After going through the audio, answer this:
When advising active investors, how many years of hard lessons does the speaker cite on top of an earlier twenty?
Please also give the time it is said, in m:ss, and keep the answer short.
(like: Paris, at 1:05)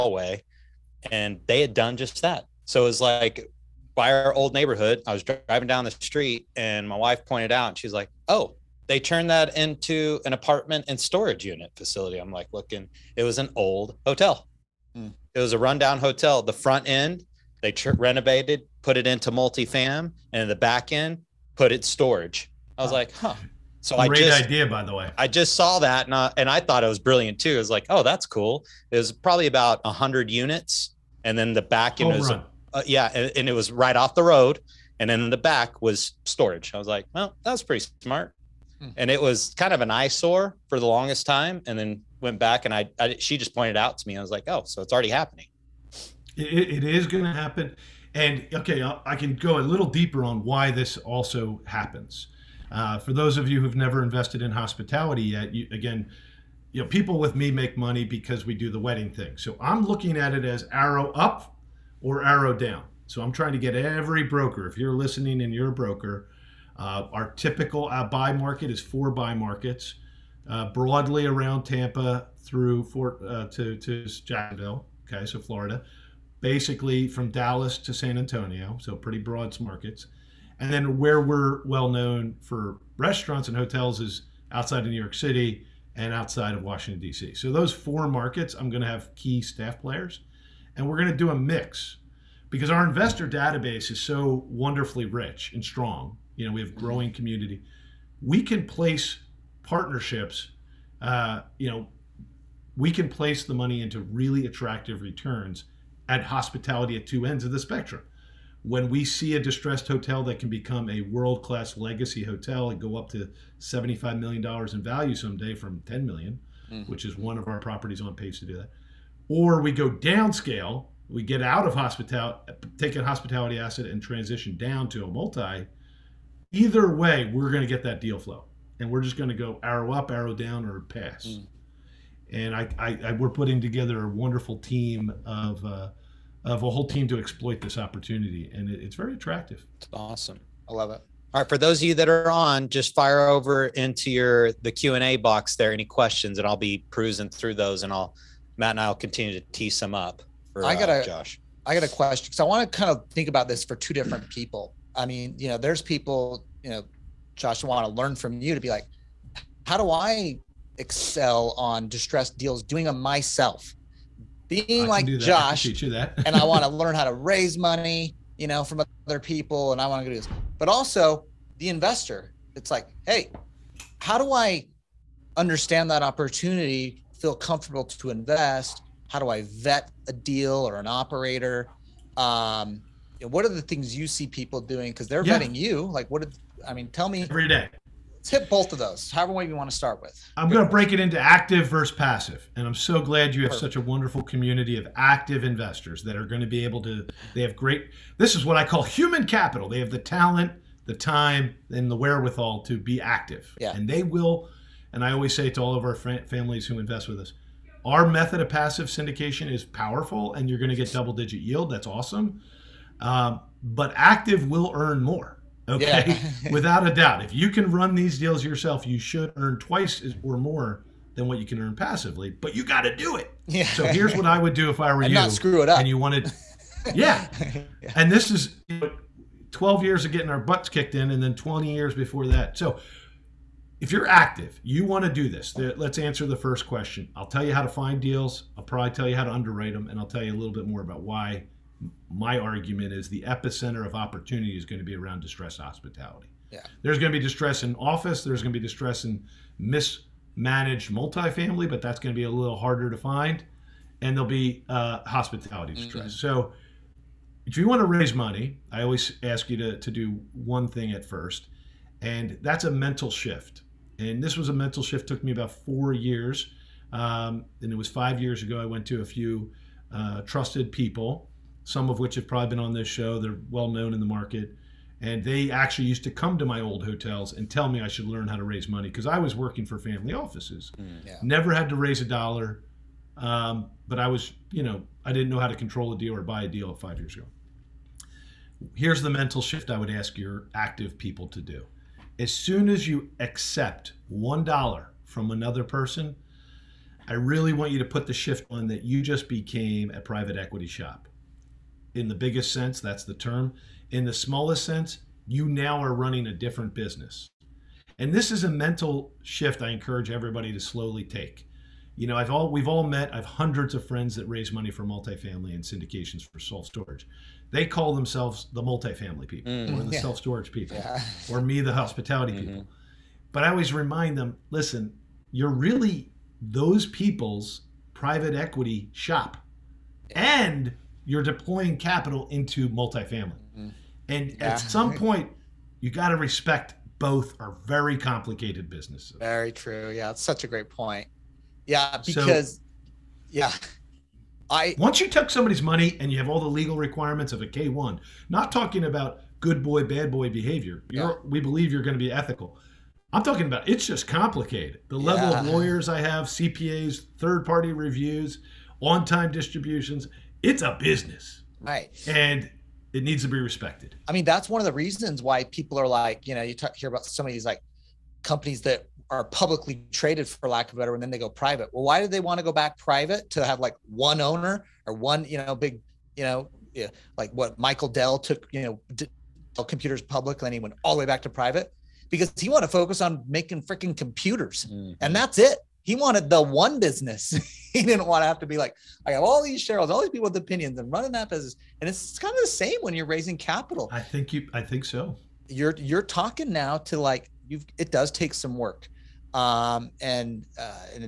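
12, at 3:49.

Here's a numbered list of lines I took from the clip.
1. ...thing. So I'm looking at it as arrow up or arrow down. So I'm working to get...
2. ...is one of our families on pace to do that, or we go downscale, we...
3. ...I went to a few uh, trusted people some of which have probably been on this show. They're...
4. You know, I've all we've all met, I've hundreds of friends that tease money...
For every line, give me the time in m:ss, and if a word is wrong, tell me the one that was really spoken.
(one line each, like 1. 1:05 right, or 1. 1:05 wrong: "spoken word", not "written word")
1. 0:59 wrong: "trying", not "working"
2. 1:57 wrong: "properties", not "families"
3. 4:28 right
4. 5:11 wrong: "raise", not "tease".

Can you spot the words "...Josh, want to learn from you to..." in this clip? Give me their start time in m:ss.
2:37.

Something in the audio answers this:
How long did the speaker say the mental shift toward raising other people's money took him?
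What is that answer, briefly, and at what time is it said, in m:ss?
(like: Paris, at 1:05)
four years, at 4:25.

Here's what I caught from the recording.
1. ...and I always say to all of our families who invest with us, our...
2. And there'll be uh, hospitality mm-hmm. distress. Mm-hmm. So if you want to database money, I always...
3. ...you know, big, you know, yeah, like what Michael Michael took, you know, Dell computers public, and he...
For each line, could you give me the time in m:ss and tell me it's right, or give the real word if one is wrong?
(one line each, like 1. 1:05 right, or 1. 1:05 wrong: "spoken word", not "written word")
1. 3:24 right
2. 4:13 wrong: "raise", not "database"
3. 6:15 wrong: "Dell", not "Michael".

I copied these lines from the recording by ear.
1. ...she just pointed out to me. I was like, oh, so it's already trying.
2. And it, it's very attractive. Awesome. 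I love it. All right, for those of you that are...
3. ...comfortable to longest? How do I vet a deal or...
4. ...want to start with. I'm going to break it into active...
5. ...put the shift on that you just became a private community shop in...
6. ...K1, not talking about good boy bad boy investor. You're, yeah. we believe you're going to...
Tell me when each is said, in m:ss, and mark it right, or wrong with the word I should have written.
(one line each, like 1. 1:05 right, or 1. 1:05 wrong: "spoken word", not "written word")
1. 0:43 wrong: "happening", not "trying"
2. 2:18 right
3. 2:57 wrong: "invest", not "longest"
4. 3:09 right
5. 4:57 wrong: "equity", not "community"
6. 5:47 wrong: "behavior", not "investor".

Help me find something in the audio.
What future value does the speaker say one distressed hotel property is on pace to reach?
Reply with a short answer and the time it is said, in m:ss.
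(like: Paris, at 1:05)
$75 million, at 1:53.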